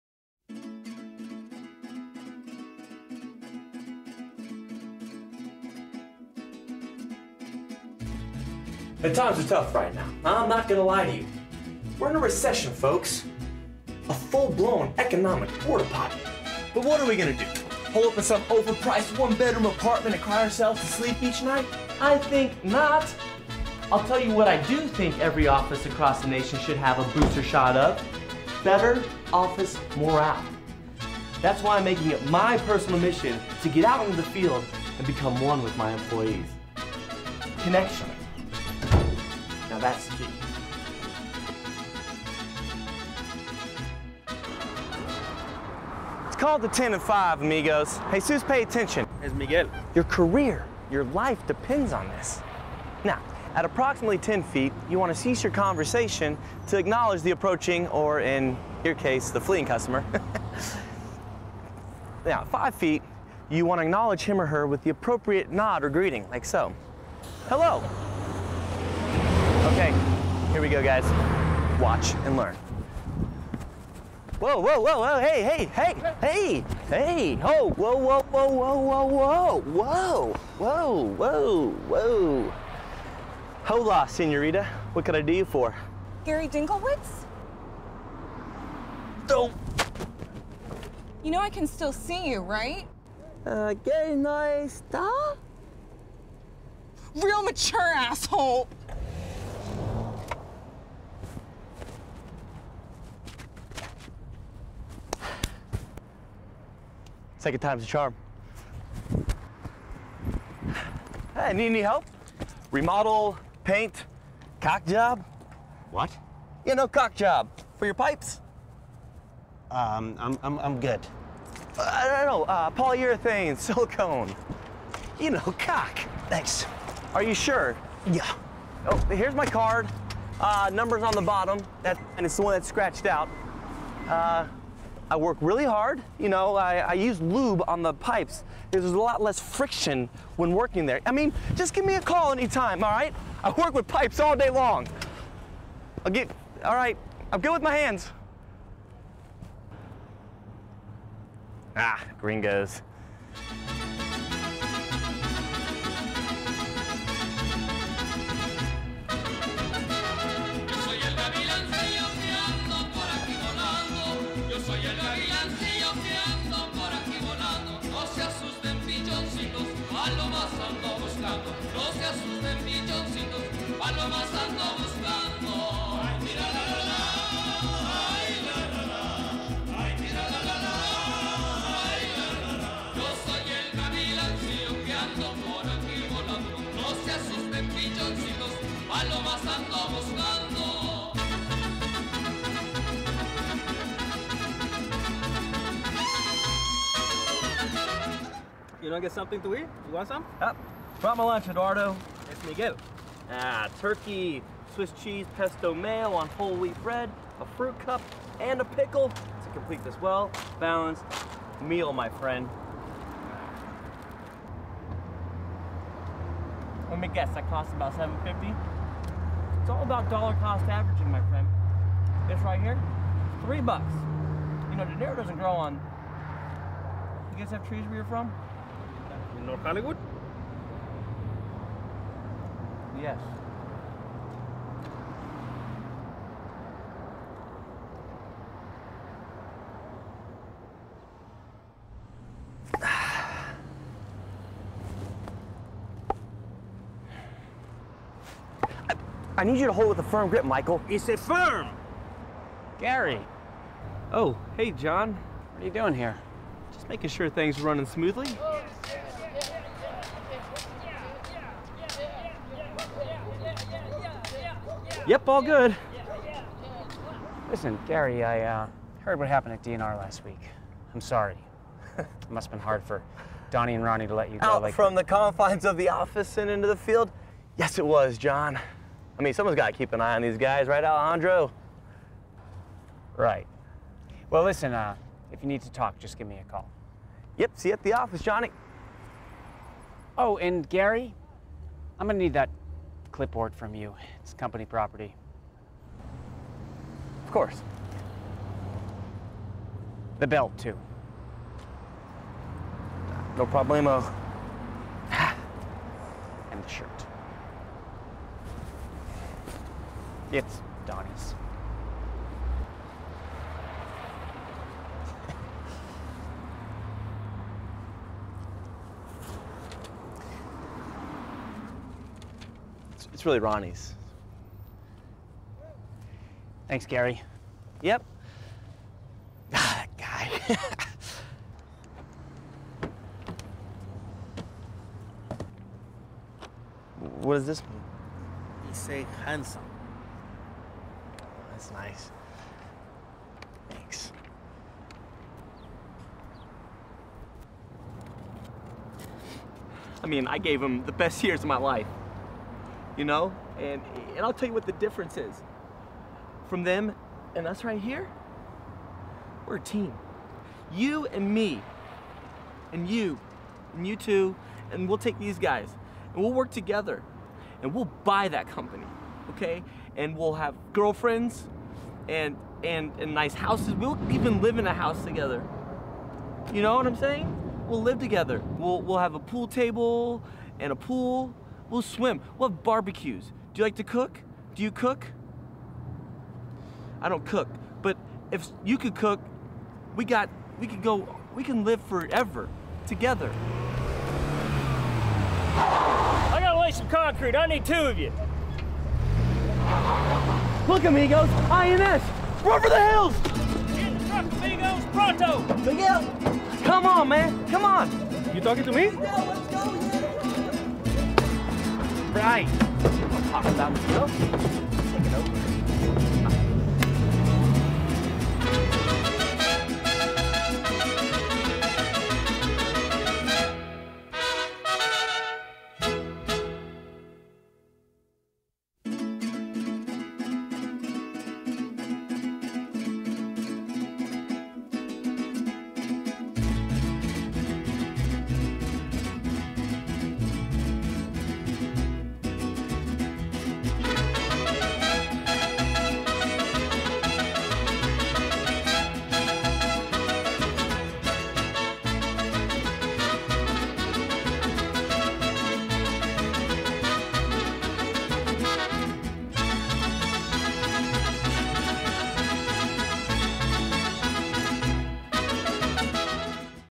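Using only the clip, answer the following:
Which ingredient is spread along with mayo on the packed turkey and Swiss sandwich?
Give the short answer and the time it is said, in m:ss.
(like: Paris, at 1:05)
pesto, at 3:25.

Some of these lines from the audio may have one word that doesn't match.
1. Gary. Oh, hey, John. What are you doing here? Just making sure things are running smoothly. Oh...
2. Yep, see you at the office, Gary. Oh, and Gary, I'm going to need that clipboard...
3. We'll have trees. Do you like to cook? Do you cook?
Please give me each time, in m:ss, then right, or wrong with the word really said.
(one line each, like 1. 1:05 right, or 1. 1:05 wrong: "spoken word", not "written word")
1. 4:12 right
2. 4:47 wrong: "Johnny", not "Gary"
3. 6:22 wrong: "barbecues", not "trees".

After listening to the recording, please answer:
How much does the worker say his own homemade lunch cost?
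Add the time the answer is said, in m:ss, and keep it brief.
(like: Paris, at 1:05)
3 bucks, at 3:43.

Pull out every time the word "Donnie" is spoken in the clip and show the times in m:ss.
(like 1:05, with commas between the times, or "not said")
4:33, 5:10.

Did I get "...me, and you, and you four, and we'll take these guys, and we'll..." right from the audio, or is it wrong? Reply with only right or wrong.
wrong.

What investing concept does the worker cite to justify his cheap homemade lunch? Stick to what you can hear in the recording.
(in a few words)
dollar cost averaging.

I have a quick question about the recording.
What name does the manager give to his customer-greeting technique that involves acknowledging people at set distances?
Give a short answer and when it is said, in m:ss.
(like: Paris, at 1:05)
the 10 to 5, at 0:46.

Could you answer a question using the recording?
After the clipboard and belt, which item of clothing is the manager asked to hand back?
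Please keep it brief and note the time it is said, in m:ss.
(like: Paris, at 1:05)
the shirt, at 5:06.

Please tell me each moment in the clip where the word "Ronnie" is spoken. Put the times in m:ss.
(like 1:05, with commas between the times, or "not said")
4:33, 5:23.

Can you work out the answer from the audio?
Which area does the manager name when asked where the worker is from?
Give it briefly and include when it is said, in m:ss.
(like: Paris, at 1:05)
North Hollywood, at 3:49.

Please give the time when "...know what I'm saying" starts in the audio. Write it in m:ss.
6:16.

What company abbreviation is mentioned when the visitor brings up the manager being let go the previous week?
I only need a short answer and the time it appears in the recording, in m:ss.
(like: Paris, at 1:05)
DNR, at 4:29.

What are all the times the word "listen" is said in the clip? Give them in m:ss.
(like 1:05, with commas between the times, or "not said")
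4:27, 4:44.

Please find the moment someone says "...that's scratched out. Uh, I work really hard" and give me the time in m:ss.
2:12.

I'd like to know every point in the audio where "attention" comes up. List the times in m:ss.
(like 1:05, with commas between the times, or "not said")
0:48.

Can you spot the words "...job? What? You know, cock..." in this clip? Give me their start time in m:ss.
1:54.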